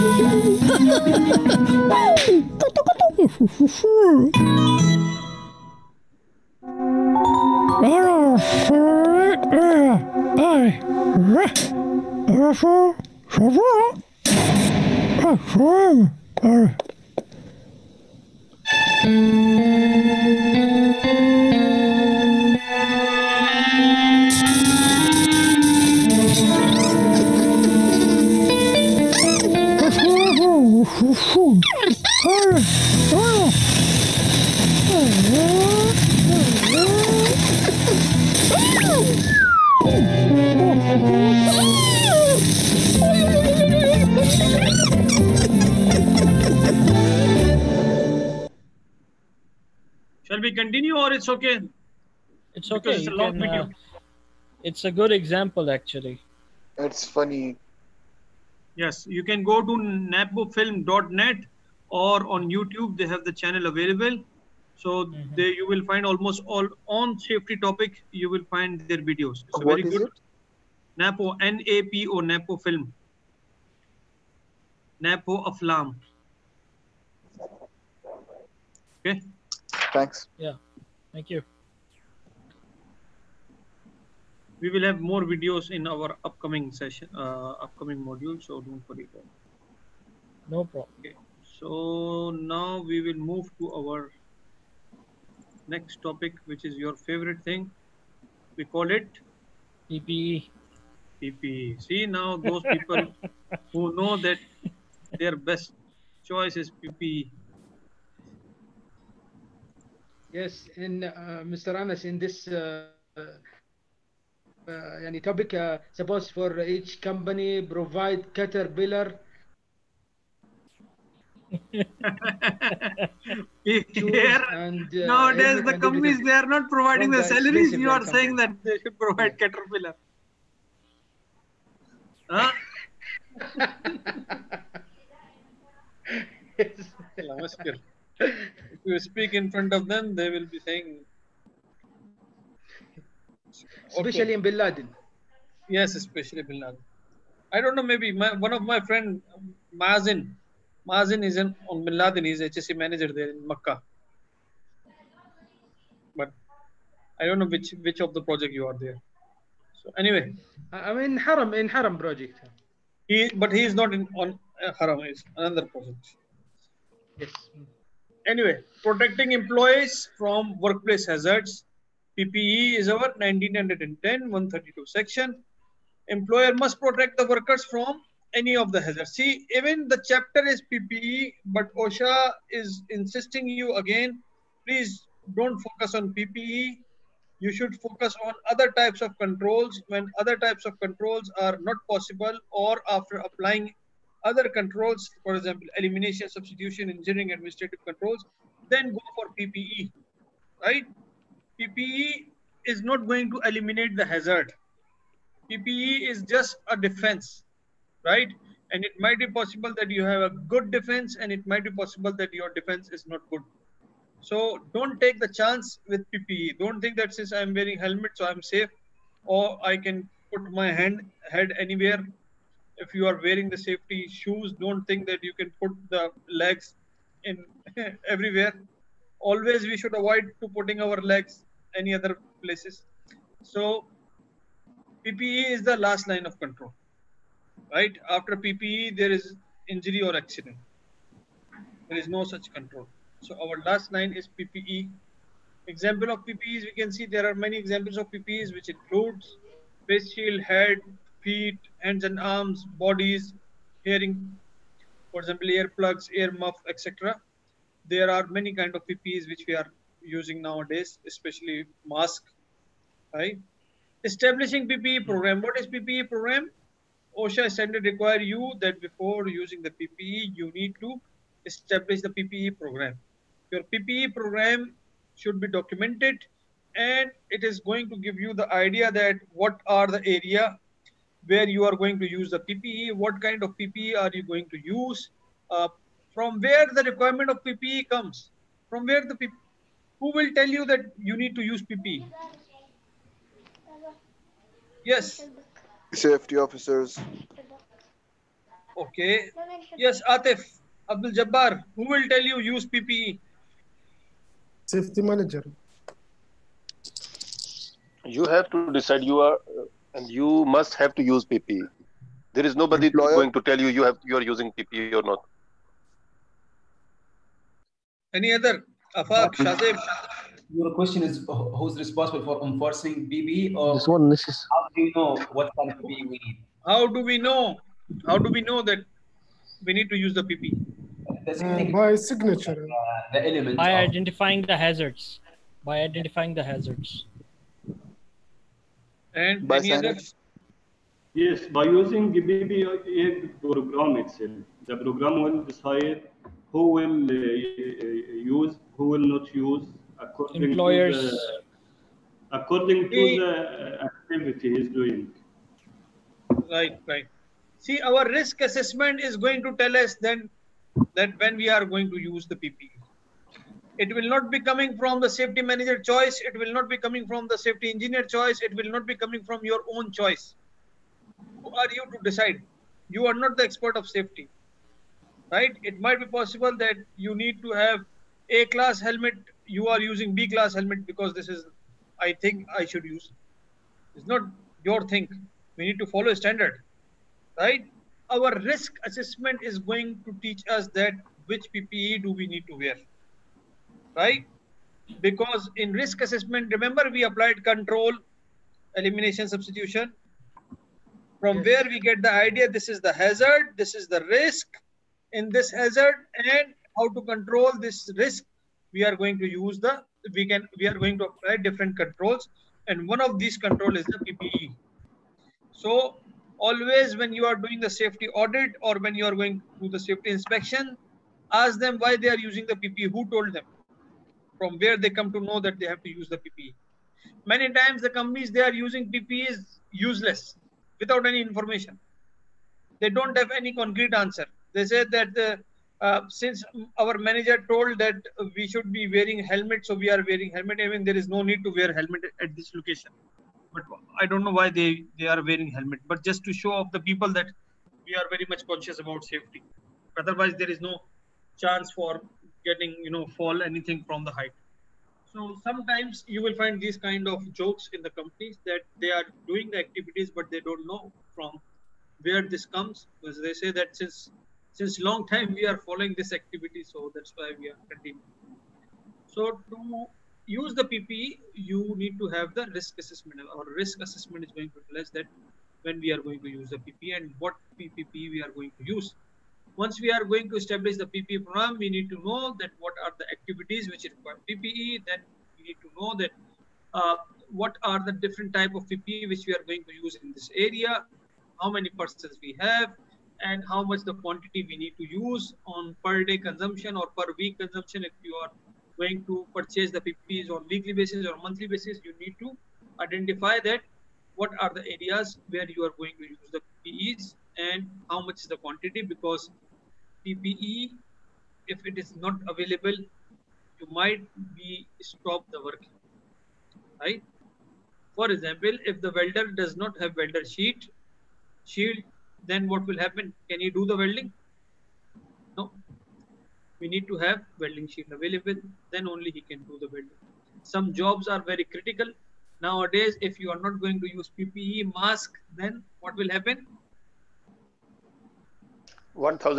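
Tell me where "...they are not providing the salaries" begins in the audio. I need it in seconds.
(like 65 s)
126 s.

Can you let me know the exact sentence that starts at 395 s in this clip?
Because in risk assessment, remember we applied control, elimination, substitution, from yes.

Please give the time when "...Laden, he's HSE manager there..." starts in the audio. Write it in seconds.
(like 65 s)
151 s.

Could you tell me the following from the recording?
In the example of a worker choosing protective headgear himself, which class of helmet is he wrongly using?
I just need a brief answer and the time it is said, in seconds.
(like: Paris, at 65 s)
B class, at 380 s.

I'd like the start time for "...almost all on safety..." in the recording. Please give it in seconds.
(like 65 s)
66 s.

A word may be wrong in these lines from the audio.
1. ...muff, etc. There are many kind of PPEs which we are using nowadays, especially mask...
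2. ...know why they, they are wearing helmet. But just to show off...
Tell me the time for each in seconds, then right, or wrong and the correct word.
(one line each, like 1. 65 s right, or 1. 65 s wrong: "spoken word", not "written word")
1. 256 s right
2. 444 s right.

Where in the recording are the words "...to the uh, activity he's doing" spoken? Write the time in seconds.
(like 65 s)
352 s.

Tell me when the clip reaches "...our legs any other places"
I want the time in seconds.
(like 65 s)
230 s.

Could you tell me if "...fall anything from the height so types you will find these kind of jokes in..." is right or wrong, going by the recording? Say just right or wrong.
wrong.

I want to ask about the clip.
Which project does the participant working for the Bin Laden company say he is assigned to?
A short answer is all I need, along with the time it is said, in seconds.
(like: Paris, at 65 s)
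Haram project, at 161 s.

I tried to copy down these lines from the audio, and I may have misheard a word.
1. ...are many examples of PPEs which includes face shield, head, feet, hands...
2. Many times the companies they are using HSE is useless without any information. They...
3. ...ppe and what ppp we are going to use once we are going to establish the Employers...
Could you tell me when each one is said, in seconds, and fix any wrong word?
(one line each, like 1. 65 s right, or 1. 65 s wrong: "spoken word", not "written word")
1. 247 s right
2. 427 s wrong: "PPE", not "HSE"
3. 476 s wrong: "PPE", not "Employers".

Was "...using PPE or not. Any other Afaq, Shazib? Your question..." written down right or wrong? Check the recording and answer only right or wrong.
right.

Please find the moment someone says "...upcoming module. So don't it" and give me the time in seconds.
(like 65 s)
87 s.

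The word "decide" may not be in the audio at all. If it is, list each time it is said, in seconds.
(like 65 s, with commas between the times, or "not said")
308 s, 345 s, 372 s.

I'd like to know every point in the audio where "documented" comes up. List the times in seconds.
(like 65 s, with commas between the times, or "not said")
275 s.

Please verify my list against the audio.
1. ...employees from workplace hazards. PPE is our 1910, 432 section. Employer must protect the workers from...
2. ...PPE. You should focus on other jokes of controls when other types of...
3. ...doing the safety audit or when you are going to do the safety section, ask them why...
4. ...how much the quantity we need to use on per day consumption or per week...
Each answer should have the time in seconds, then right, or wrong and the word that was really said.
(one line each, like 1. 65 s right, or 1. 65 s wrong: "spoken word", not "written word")
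1. 169 s wrong: "132", not "432"
2. 186 s wrong: "types", not "jokes"
3. 417 s wrong: "inspection", not "section"
4. 493 s right.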